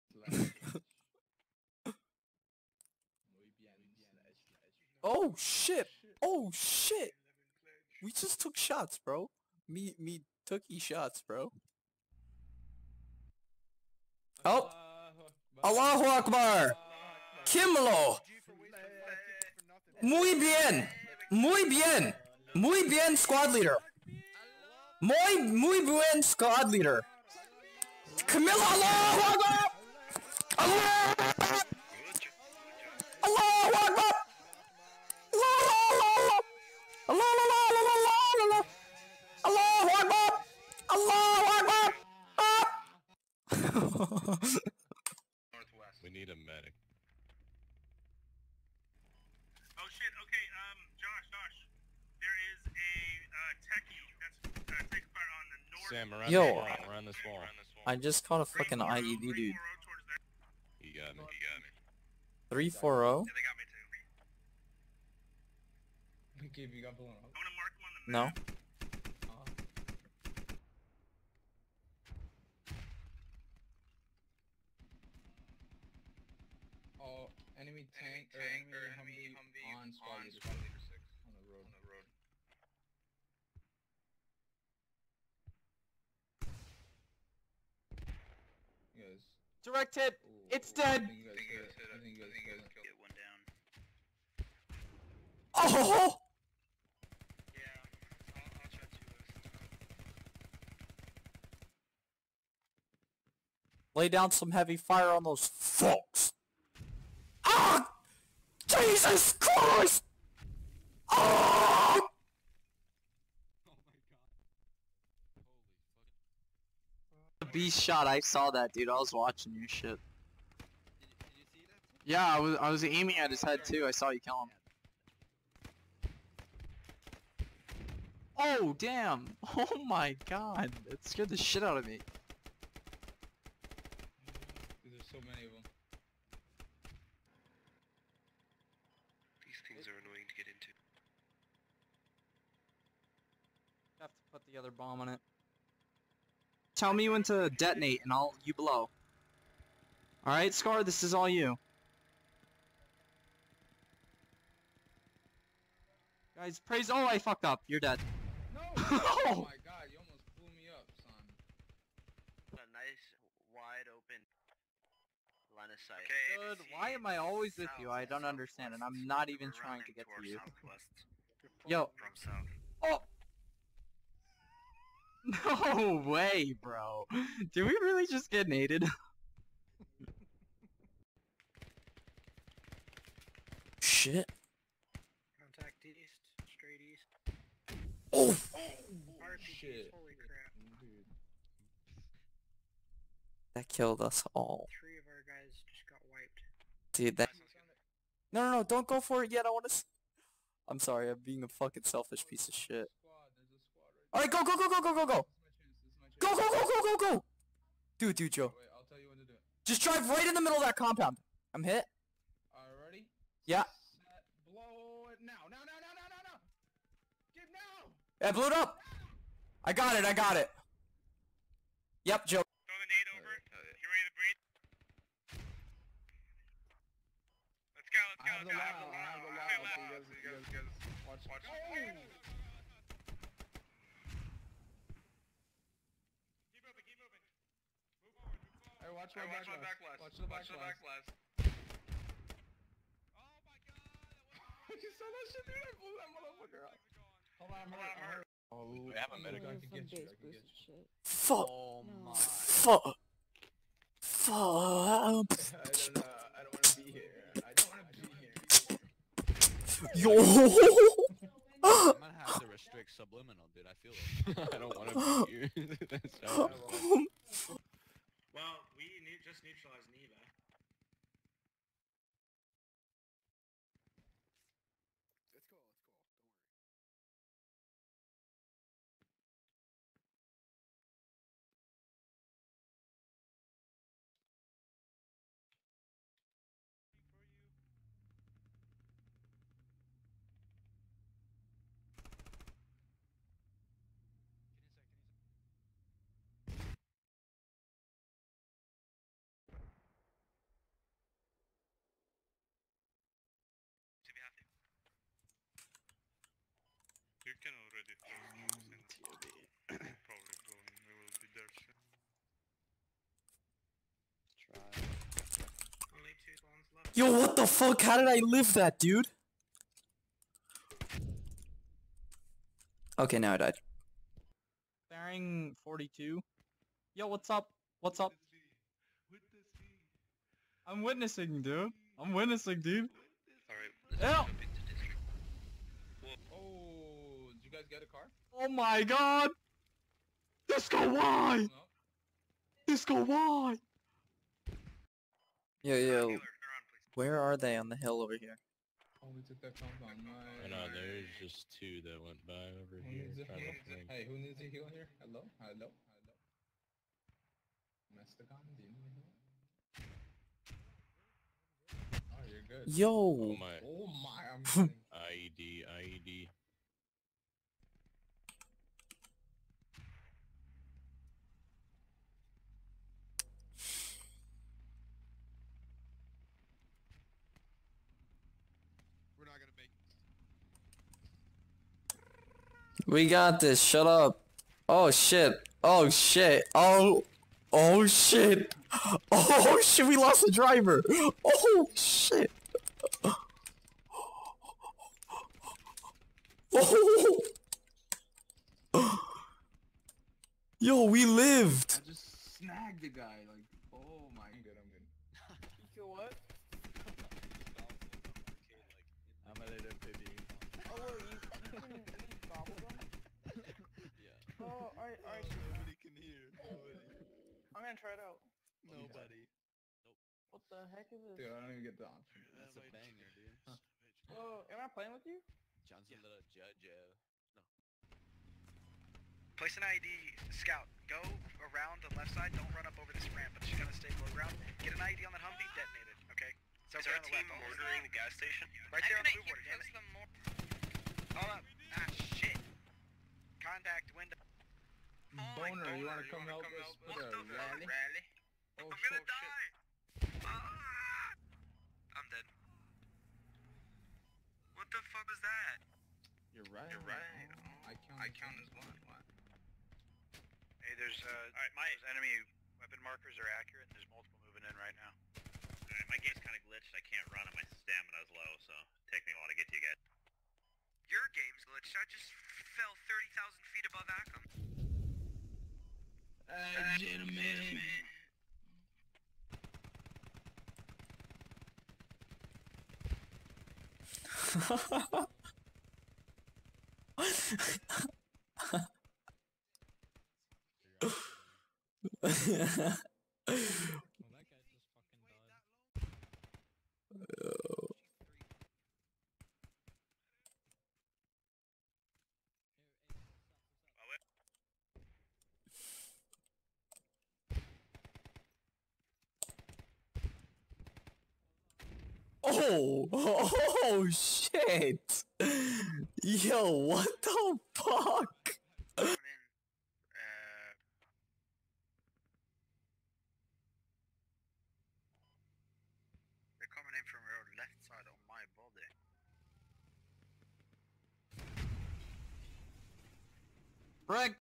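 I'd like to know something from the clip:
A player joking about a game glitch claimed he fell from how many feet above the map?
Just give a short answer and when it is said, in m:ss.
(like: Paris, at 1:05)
30,000, at 7:52.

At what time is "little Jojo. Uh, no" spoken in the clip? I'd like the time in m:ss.
7:06.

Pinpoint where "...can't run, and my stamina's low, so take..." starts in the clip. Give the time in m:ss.
7:46.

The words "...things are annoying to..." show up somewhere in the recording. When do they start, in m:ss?
2:19.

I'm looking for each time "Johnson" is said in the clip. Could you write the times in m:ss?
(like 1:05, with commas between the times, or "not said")
7:05.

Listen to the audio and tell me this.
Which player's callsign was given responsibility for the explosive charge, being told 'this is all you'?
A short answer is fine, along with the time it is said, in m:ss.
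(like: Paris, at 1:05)
Scar, at 2:30.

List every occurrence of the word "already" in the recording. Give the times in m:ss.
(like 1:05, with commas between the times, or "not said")
3:32, 5:07.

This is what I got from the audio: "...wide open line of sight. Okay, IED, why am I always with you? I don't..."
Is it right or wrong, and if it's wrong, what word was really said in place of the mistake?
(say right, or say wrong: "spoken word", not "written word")
wrong: "Good", not "IED".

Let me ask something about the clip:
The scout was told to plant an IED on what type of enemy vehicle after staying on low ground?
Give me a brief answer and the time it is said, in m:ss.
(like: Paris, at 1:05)
Humvee, at 7:15.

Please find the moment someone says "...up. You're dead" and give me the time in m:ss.
2:37.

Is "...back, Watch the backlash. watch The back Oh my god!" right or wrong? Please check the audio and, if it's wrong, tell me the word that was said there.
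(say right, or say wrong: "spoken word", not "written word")
right.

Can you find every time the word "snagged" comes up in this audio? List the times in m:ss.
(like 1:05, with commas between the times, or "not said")
6:42.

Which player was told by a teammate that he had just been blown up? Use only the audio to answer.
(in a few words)
Gabe.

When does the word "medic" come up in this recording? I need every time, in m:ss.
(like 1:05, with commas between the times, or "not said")
0:46, 4:09.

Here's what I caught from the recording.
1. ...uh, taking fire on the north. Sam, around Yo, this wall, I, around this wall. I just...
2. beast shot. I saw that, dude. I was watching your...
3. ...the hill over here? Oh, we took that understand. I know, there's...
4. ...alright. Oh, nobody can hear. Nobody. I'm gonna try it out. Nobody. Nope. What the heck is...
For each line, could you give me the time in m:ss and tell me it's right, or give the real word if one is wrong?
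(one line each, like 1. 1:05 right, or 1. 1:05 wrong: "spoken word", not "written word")
1. 0:54 right
2. 1:57 right
3. 5:47 wrong: "compound", not "understand"
4. 6:55 right.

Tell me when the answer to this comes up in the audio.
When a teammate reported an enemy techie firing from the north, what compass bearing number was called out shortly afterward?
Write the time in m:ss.
1:02.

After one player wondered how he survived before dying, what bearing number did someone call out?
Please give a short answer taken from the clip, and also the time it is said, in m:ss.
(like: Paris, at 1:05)
42, at 5:24.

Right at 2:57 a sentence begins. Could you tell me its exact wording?
Did we really just get naded?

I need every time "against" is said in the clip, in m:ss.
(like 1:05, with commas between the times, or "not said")
not said.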